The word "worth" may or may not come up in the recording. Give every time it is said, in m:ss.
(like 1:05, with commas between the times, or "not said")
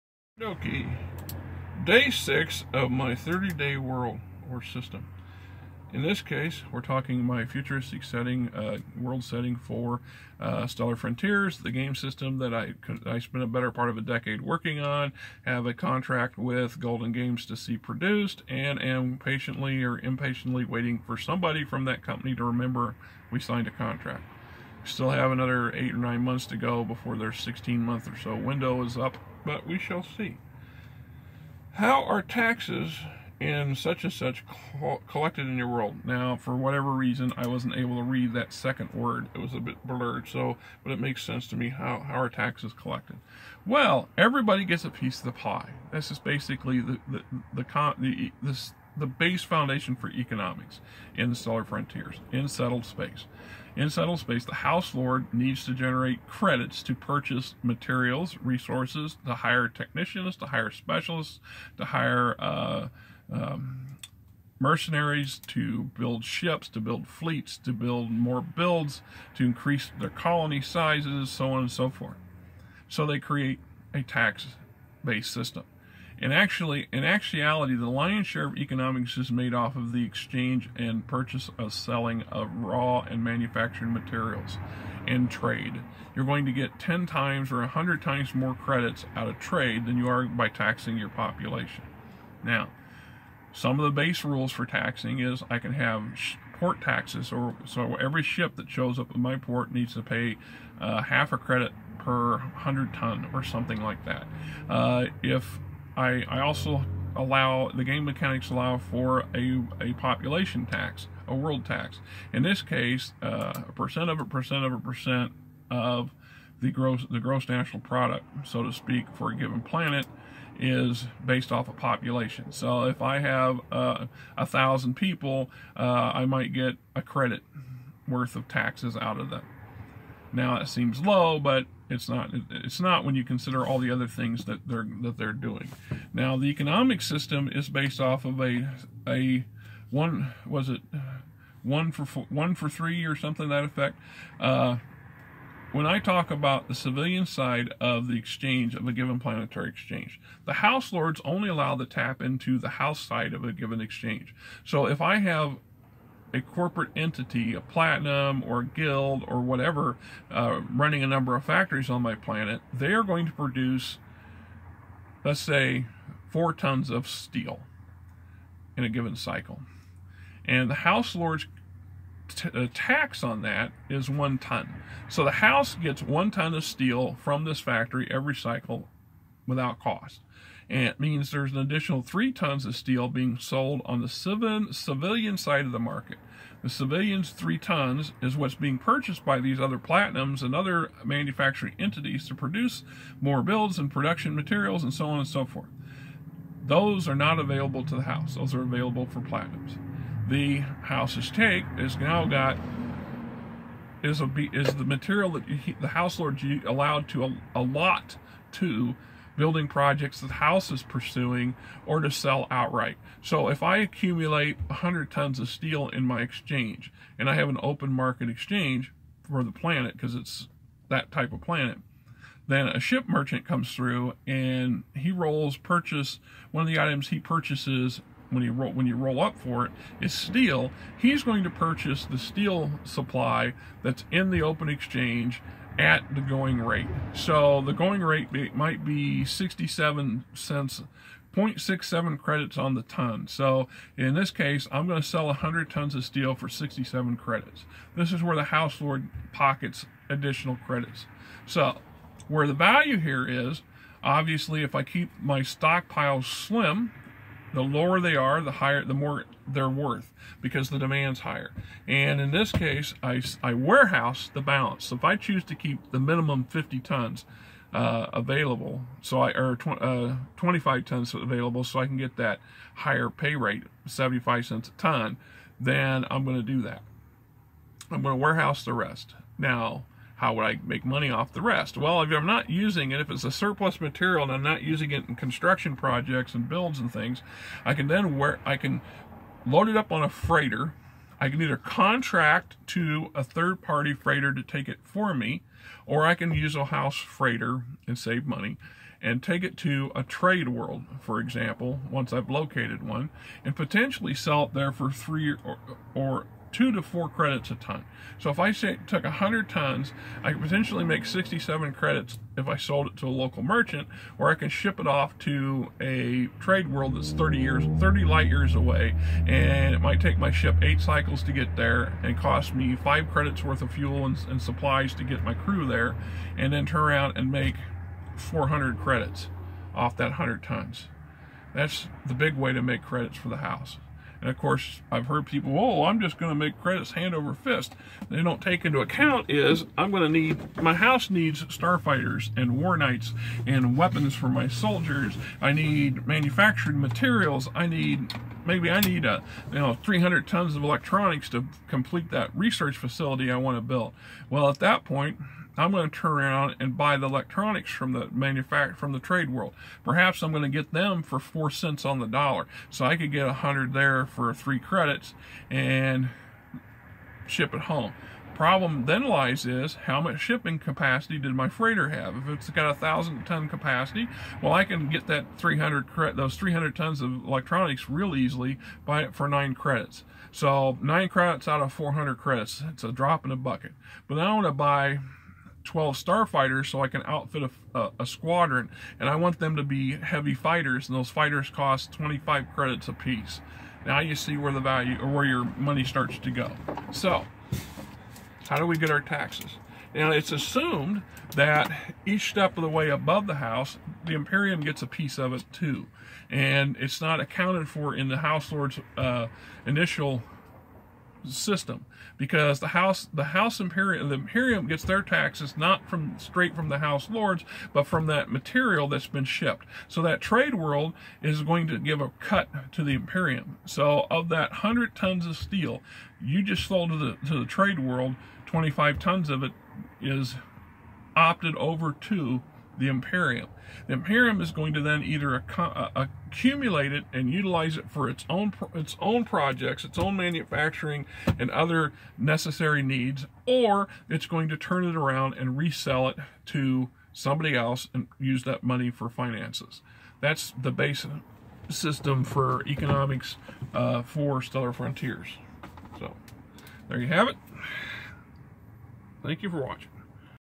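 2:08, 4:19, 5:23.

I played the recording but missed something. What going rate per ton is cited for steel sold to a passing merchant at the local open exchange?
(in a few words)
0.67 credits.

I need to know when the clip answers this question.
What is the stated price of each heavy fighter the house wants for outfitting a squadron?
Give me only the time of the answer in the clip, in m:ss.
6:31.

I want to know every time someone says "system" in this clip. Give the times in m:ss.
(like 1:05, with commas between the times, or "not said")
0:04, 0:11, 1:15, 2:17, 6:51, 7:31.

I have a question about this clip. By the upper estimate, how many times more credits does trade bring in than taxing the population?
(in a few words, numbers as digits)
100.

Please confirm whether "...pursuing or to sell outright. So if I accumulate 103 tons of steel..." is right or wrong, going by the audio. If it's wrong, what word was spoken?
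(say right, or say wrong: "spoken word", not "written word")
wrong: "100", not "103".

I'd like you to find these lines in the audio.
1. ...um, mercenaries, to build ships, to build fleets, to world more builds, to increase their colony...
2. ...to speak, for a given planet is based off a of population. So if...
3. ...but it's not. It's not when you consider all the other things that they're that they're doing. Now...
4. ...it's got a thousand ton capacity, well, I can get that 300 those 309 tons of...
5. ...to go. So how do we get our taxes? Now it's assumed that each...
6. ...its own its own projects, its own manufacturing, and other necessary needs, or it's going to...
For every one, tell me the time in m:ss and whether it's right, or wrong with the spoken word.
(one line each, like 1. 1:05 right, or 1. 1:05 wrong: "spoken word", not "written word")
1. 1:03 wrong: "build", not "world"
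2. 1:58 right
3. 2:11 right
4. 6:12 wrong: "300", not "309"
5. 6:36 right
6. 7:18 right.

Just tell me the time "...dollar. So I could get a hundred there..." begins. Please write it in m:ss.
6:02.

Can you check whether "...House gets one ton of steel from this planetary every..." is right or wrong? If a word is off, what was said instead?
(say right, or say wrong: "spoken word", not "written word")
wrong: "factory", not "planetary".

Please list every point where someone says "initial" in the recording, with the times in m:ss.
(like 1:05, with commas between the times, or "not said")
6:49.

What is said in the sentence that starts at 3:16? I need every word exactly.
Those are not available to the house.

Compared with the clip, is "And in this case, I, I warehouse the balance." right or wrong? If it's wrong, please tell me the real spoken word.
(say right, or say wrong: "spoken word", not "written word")
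right.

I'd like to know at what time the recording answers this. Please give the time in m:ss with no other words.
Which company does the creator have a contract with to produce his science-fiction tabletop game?
0:16.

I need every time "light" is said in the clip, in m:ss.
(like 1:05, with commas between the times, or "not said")
5:18.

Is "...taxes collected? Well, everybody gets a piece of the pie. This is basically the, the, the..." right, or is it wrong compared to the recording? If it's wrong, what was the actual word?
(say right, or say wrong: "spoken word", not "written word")
right.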